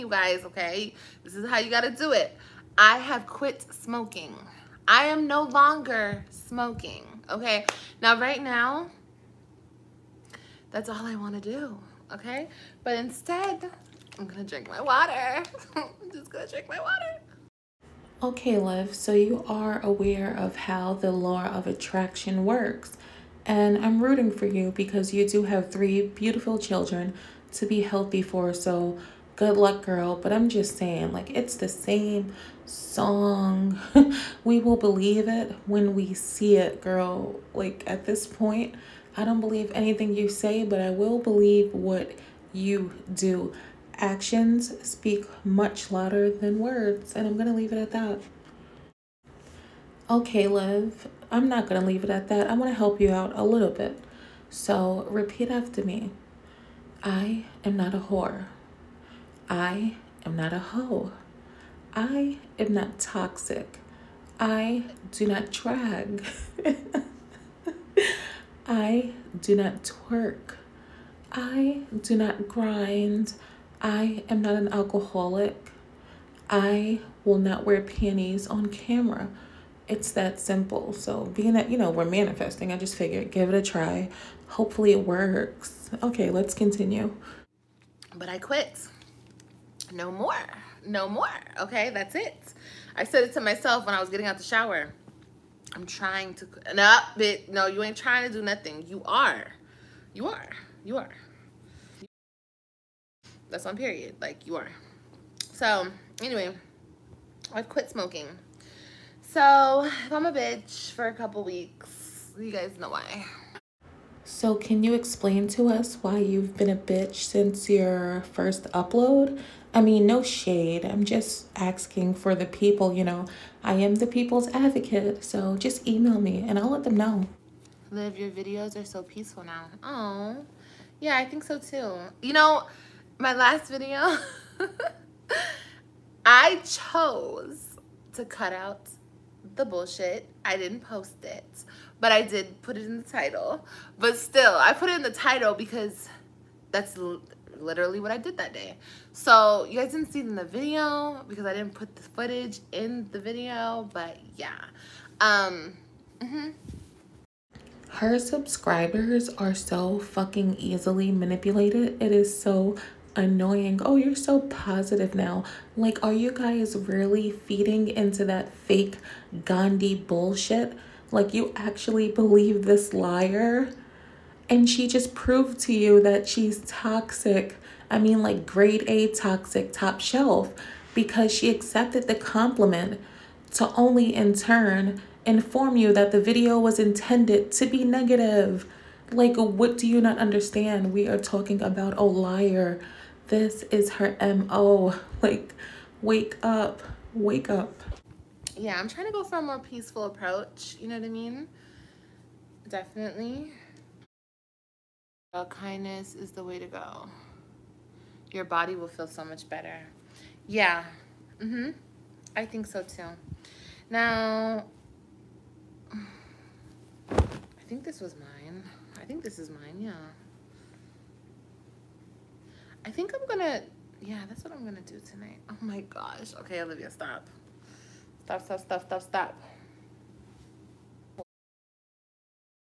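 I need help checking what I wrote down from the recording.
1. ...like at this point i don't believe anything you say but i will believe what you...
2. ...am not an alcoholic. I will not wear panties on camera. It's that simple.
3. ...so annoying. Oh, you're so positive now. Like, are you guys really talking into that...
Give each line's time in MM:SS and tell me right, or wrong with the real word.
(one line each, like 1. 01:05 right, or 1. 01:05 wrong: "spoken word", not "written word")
1. 00:37 right
2. 01:14 right
3. 02:42 wrong: "feeding", not "talking".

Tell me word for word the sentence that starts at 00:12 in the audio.
But instead, I'm gonna drink my water.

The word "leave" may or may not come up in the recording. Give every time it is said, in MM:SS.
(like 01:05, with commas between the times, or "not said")
00:47, 00:51.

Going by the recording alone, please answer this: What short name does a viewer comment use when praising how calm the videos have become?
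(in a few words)
Liv.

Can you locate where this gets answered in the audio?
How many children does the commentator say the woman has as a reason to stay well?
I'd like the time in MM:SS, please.
00:25.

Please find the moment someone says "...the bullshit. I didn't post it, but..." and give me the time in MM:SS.
02:19.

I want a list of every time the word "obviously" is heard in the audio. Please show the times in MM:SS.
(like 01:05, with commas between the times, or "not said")
not said.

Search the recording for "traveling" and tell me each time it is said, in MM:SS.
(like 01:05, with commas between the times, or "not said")
not said.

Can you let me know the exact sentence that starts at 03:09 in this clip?
Like, what do you not understand?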